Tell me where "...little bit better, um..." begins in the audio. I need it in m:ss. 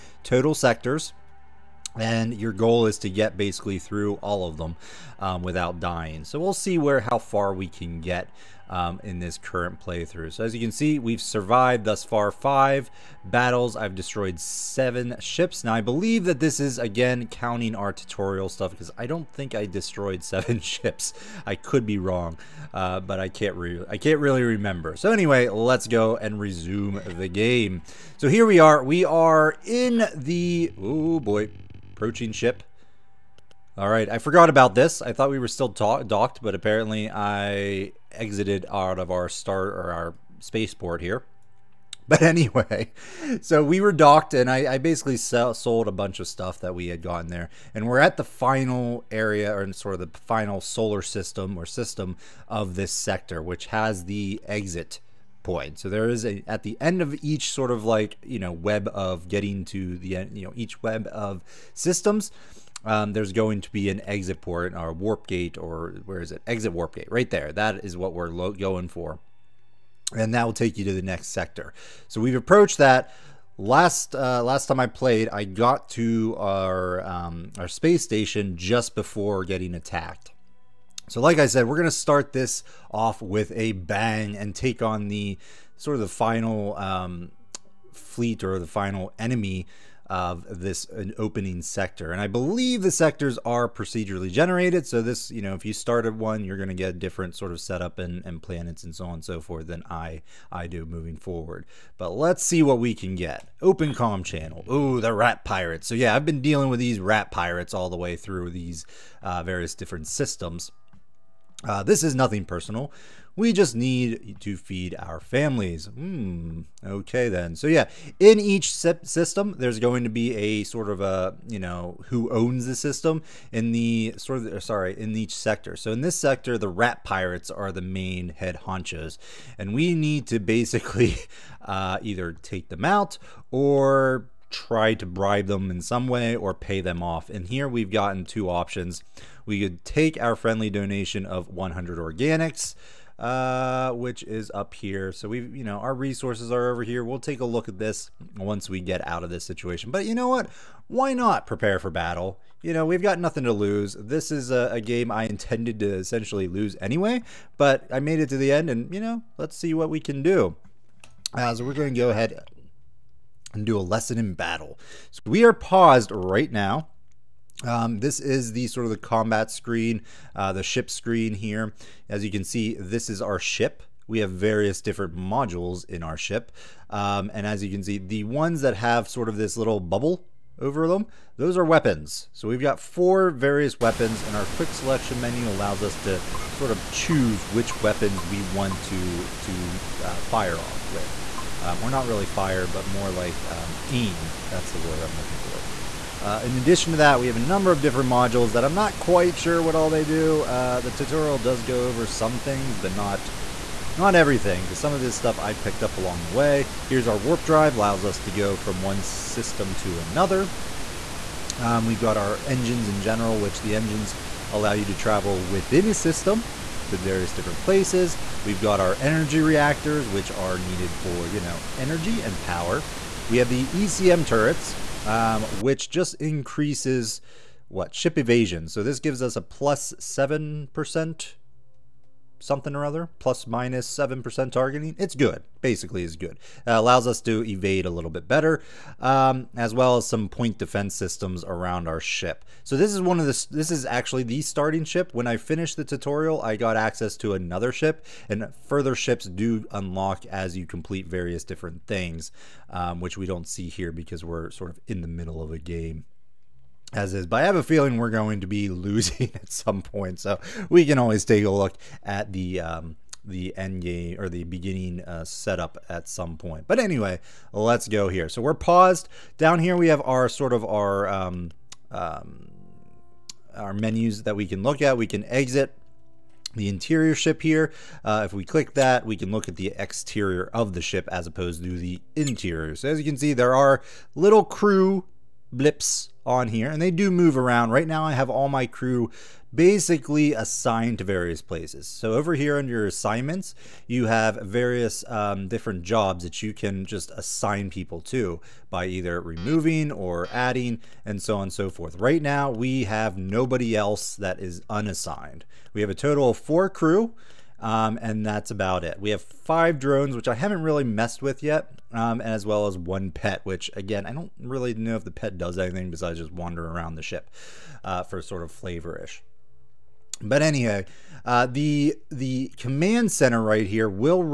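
3:57.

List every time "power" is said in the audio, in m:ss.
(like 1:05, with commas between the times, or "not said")
3:42.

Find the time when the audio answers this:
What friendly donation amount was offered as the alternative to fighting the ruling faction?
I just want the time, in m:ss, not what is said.
2:21.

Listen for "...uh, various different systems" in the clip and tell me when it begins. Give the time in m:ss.
1:49.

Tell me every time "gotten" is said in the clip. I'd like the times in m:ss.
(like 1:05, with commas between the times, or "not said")
0:46, 2:17.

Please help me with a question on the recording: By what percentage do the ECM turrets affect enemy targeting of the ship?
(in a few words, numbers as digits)
7%.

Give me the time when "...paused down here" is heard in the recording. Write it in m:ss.
4:28.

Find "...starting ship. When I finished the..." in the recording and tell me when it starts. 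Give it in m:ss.
4:04.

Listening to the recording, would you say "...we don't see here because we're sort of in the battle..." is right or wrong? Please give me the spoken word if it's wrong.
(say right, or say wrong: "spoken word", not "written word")
wrong: "middle", not "battle".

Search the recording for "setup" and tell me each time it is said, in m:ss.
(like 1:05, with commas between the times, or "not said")
1:37, 4:25.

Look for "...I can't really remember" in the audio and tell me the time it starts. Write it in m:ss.
0:23.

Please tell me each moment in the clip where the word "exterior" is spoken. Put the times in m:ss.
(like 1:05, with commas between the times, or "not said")
4:39.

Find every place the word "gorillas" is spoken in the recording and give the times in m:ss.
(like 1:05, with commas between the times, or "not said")
not said.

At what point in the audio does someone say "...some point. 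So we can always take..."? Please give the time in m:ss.
4:19.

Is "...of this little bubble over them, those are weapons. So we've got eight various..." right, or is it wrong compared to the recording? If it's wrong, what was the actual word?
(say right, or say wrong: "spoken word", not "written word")
wrong: "four", not "eight".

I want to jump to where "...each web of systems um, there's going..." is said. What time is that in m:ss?
1:00.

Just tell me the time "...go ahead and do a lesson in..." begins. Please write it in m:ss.
2:41.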